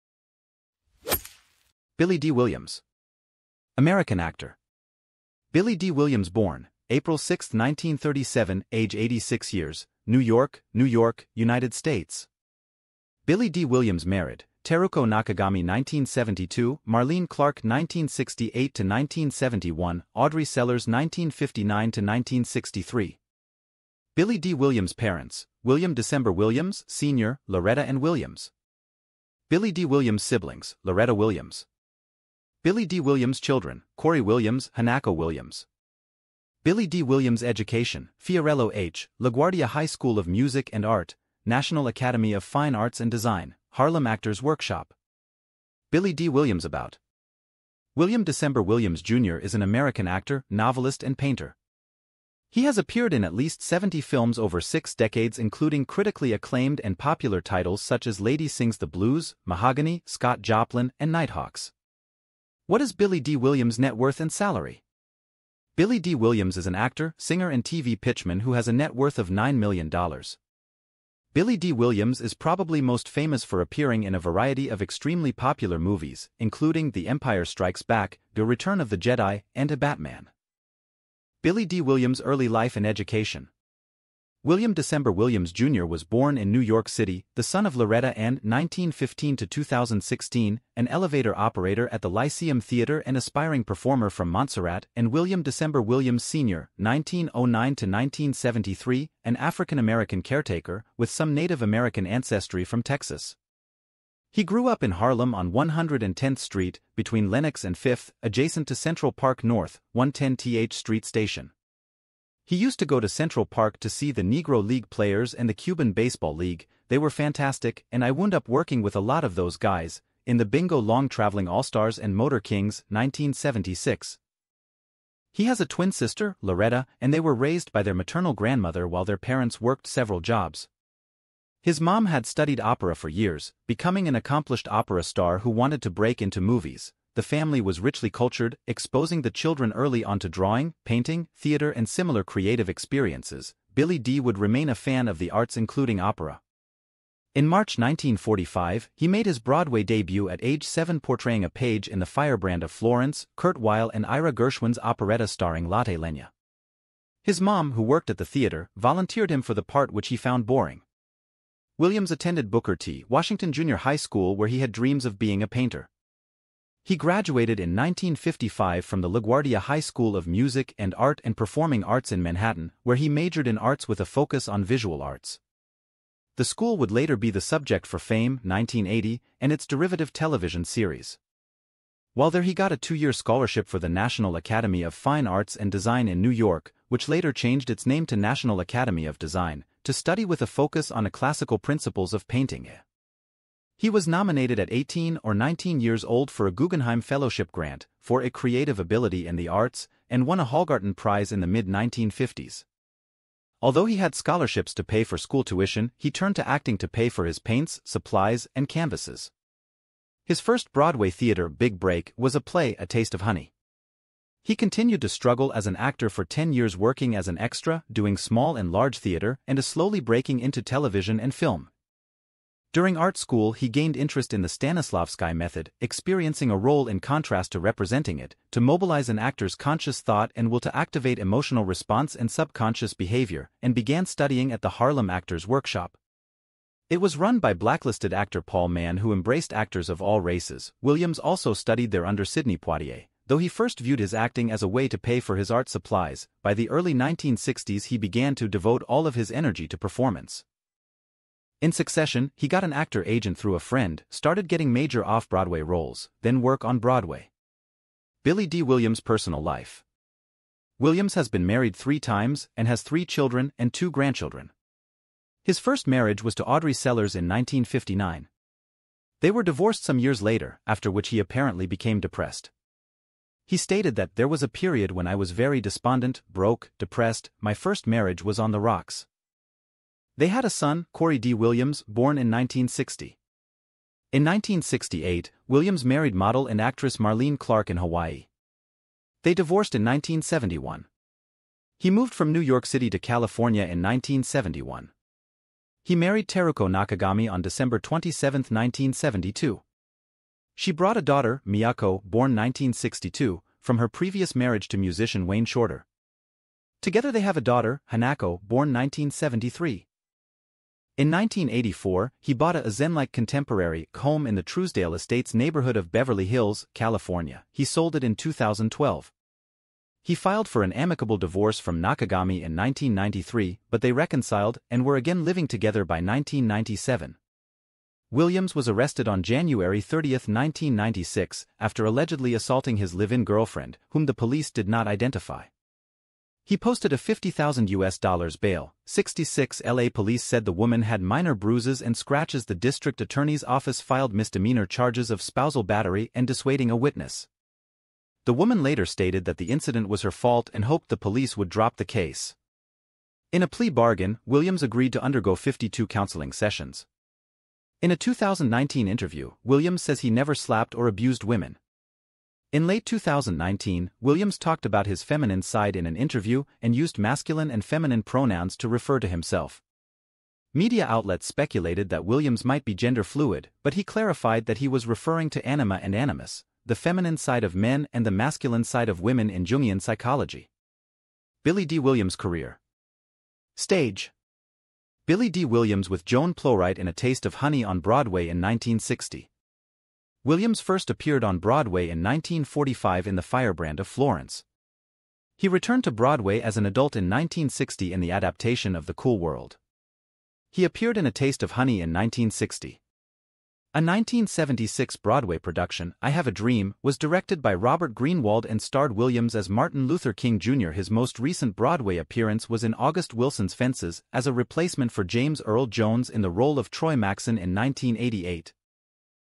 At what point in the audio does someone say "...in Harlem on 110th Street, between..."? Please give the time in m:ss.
1:44.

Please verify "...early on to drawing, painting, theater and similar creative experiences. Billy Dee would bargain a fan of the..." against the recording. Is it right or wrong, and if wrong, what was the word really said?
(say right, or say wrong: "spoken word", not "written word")
wrong: "remain", not "bargain".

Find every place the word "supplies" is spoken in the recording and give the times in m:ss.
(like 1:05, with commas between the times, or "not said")
3:27, 4:05.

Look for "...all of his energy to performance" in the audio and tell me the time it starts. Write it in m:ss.
4:08.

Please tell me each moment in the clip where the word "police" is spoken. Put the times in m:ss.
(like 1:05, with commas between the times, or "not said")
5:34, 5:39, 5:50.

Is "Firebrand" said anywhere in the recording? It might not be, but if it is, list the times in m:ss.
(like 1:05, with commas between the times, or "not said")
2:32, 6:33.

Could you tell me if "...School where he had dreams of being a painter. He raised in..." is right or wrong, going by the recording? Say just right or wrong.
wrong.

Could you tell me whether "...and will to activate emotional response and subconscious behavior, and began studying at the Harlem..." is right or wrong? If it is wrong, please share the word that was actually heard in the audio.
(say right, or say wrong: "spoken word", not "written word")
right.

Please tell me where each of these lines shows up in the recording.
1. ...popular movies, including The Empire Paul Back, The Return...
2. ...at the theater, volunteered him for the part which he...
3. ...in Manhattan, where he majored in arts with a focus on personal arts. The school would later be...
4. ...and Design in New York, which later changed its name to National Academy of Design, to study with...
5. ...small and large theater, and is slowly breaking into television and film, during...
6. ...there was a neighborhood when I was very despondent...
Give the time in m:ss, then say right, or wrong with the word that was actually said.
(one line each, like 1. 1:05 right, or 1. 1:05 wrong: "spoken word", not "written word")
1. 1:15 wrong: "Strikes", not "Paul"
2. 2:38 right
3. 2:52 wrong: "visual", not "personal"
4. 3:05 right
5. 3:38 right
6. 4:34 wrong: "period", not "neighborhood".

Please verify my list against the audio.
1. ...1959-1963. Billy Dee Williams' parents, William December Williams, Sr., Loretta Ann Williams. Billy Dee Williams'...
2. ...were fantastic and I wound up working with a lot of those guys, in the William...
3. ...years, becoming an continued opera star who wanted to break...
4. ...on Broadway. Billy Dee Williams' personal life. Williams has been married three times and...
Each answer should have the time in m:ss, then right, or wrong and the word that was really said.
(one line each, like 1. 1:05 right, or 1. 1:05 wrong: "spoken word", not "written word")
1. 0:20 right
2. 1:56 wrong: "Bingo", not "William"
3. 2:13 wrong: "accomplished", not "continued"
4. 4:16 right.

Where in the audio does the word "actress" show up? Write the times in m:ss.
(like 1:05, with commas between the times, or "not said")
4:46.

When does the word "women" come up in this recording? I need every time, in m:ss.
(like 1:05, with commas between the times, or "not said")
6:01, 6:18.